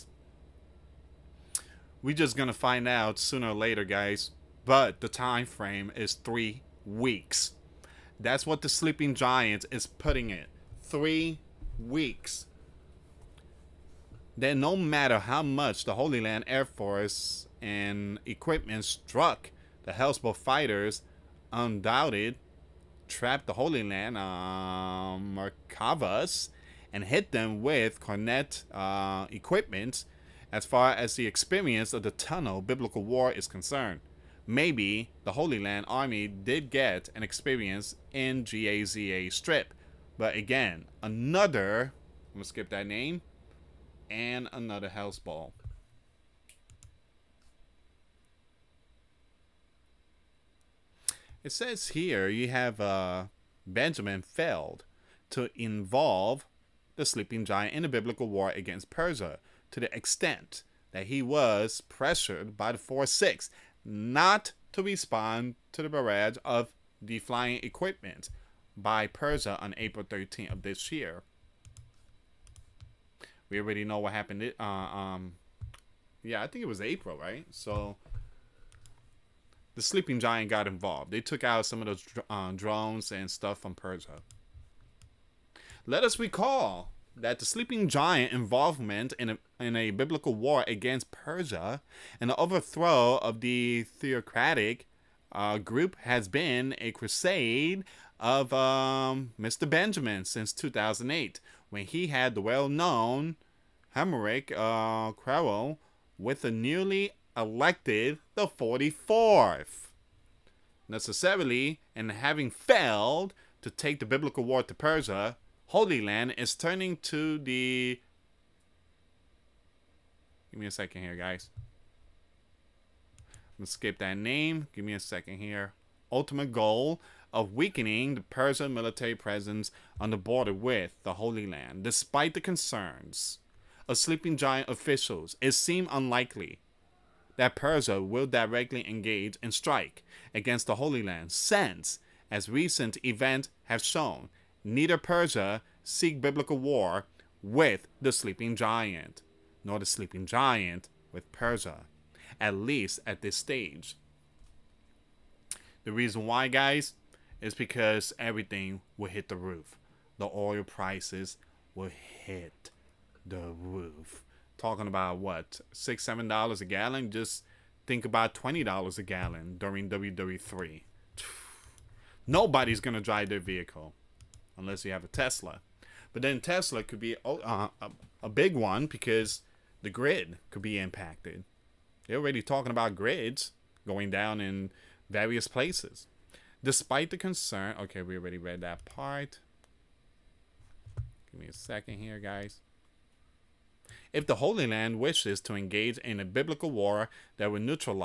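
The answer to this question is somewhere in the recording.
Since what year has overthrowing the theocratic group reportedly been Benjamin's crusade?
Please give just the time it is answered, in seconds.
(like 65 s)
100 s.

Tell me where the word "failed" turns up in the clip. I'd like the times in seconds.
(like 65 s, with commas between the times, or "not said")
54 s, 112 s.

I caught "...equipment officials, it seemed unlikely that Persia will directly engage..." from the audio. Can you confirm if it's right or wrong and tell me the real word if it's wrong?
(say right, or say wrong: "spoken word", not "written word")
wrong: "giant", not "equipment".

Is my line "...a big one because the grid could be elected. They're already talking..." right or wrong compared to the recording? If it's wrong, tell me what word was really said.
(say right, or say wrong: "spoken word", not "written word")
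wrong: "impacted", not "elected".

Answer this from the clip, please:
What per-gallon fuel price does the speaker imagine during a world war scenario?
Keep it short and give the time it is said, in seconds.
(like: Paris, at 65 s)
$20, at 168 s.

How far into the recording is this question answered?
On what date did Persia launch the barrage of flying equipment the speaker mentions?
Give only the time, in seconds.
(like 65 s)
69 s.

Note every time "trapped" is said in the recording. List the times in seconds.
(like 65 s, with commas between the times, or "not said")
23 s.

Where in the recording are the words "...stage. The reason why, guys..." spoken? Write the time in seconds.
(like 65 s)
153 s.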